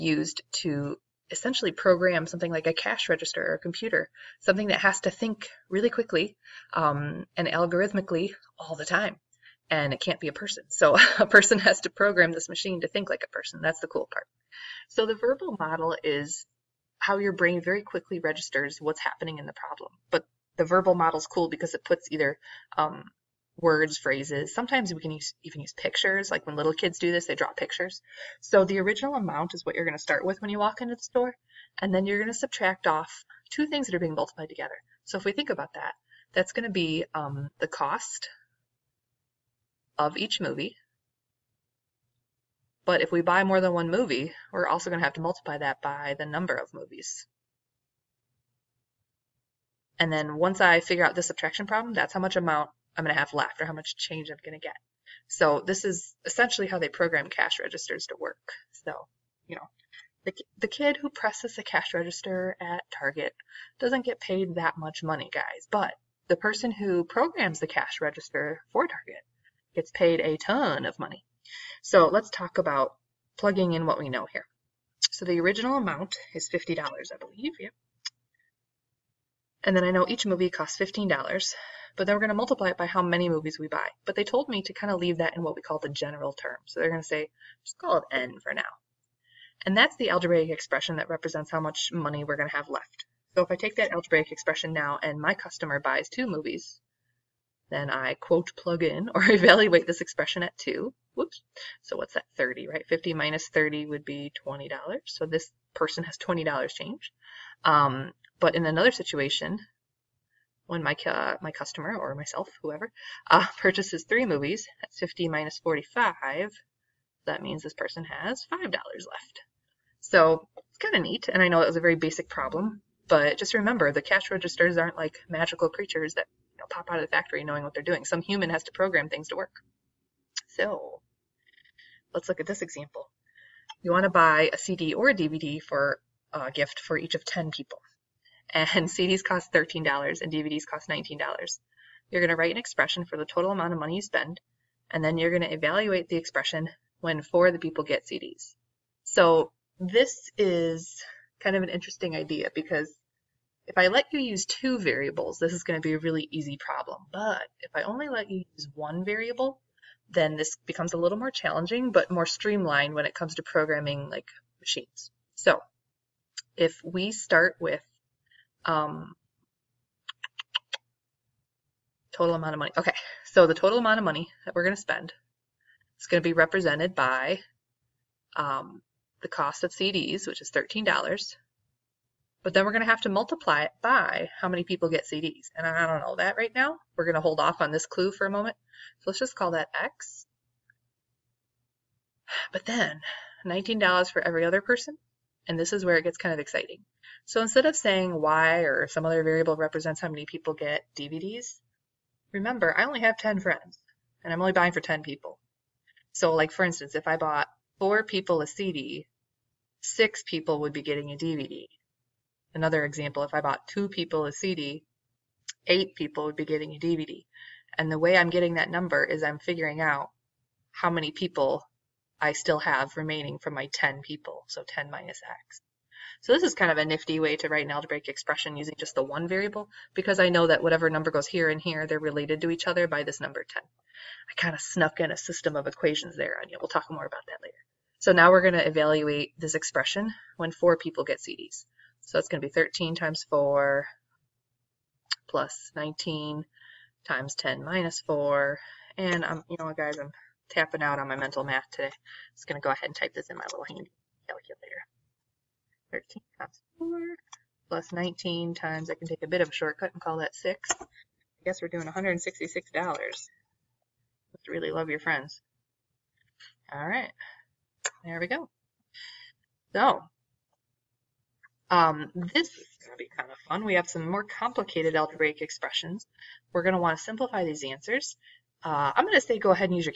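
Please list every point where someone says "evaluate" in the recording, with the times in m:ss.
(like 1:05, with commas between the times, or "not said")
1:39, 2:25, 3:58.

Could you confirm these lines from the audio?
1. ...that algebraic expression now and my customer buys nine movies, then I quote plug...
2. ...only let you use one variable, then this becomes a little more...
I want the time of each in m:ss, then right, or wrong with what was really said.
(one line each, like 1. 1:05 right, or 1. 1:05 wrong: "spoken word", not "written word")
1. 1:33 wrong: "two", not "nine"
2. 2:37 right.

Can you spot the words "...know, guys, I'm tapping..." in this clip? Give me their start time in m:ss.
4:09.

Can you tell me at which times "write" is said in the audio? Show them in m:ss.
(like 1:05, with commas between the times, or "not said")
2:22, 3:47.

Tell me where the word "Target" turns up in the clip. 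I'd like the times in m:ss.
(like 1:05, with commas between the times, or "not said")
1:02, 1:08.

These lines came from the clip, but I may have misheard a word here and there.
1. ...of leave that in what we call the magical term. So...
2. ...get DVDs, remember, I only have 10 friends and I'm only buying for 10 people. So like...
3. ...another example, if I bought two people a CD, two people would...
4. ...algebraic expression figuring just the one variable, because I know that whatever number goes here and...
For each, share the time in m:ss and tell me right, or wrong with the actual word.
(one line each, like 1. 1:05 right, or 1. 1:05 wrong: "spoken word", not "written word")
1. 1:24 wrong: "general", not "magical"
2. 3:20 right
3. 3:32 wrong: "eight", not "two"
4. 3:47 wrong: "using", not "figuring".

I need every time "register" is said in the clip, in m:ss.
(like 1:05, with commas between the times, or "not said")
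0:03, 0:18, 0:57, 1:01, 1:07, 2:04.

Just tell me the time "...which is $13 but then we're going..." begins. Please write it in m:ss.
3:00.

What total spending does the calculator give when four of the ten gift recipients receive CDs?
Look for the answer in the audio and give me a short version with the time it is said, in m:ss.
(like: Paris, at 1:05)
$166, at 4:21.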